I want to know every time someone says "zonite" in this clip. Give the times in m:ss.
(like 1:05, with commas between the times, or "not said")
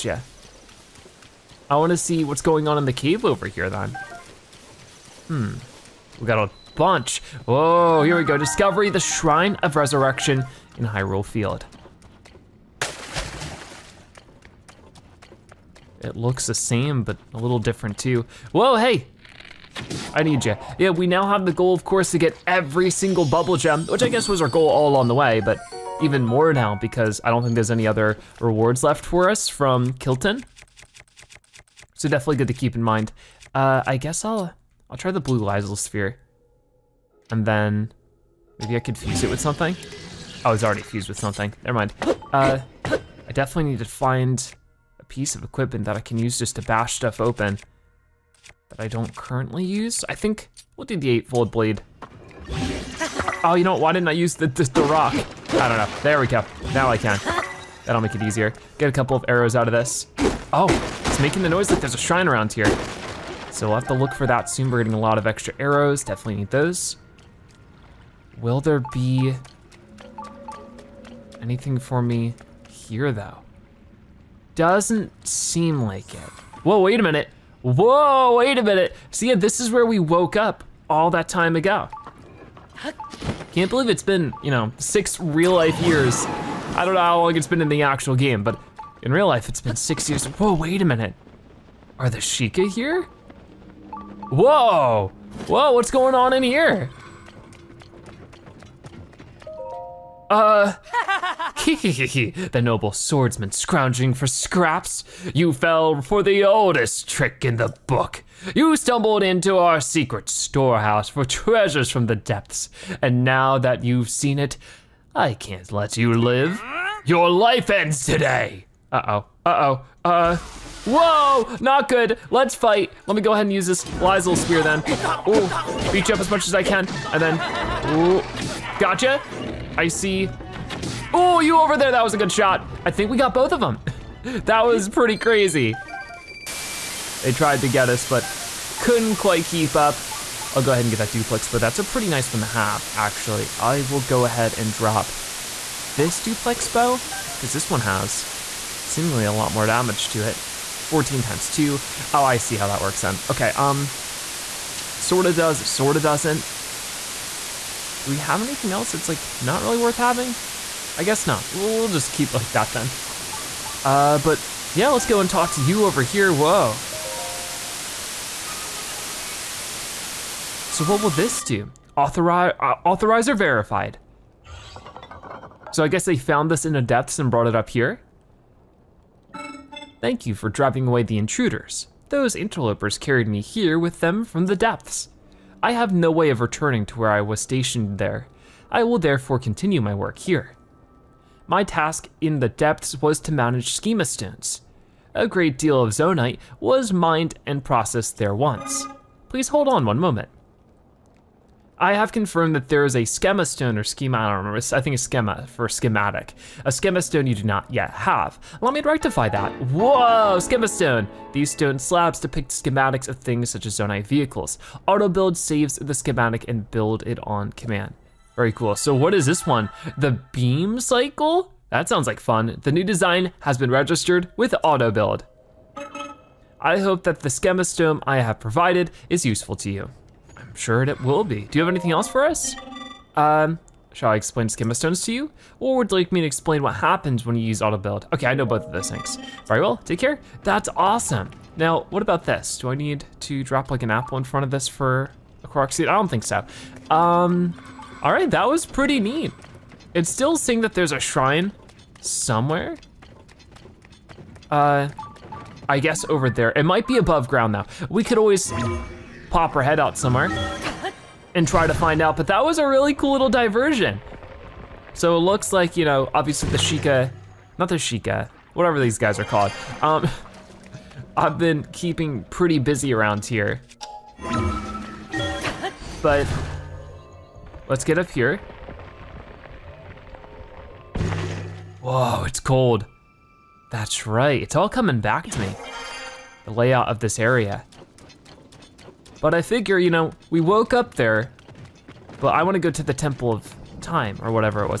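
3:15, 3:33.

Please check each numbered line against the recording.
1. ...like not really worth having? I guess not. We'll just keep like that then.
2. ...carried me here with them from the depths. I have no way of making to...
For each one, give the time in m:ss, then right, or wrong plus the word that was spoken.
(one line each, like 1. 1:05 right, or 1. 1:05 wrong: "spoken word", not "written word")
1. 2:39 right
2. 3:02 wrong: "returning", not "making".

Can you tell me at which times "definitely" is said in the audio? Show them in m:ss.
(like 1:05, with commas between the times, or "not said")
0:32, 0:43, 1:06.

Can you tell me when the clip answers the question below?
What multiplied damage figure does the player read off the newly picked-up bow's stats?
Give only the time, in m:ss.
2:30.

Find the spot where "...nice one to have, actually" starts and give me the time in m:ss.
2:22.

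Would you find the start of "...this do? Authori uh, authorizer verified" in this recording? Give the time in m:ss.
2:51.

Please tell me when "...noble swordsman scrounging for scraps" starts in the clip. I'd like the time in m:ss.
1:42.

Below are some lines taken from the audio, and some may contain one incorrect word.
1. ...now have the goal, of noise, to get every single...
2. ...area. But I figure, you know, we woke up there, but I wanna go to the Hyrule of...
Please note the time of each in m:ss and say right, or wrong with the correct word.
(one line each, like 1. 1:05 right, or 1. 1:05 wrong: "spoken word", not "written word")
1. 0:21 wrong: "course", not "noise"
2. 4:47 wrong: "Temple", not "Hyrule".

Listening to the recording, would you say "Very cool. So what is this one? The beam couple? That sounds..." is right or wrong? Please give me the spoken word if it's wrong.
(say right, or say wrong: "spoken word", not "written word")
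wrong: "cycle", not "couple".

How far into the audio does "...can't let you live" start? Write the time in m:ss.
1:55.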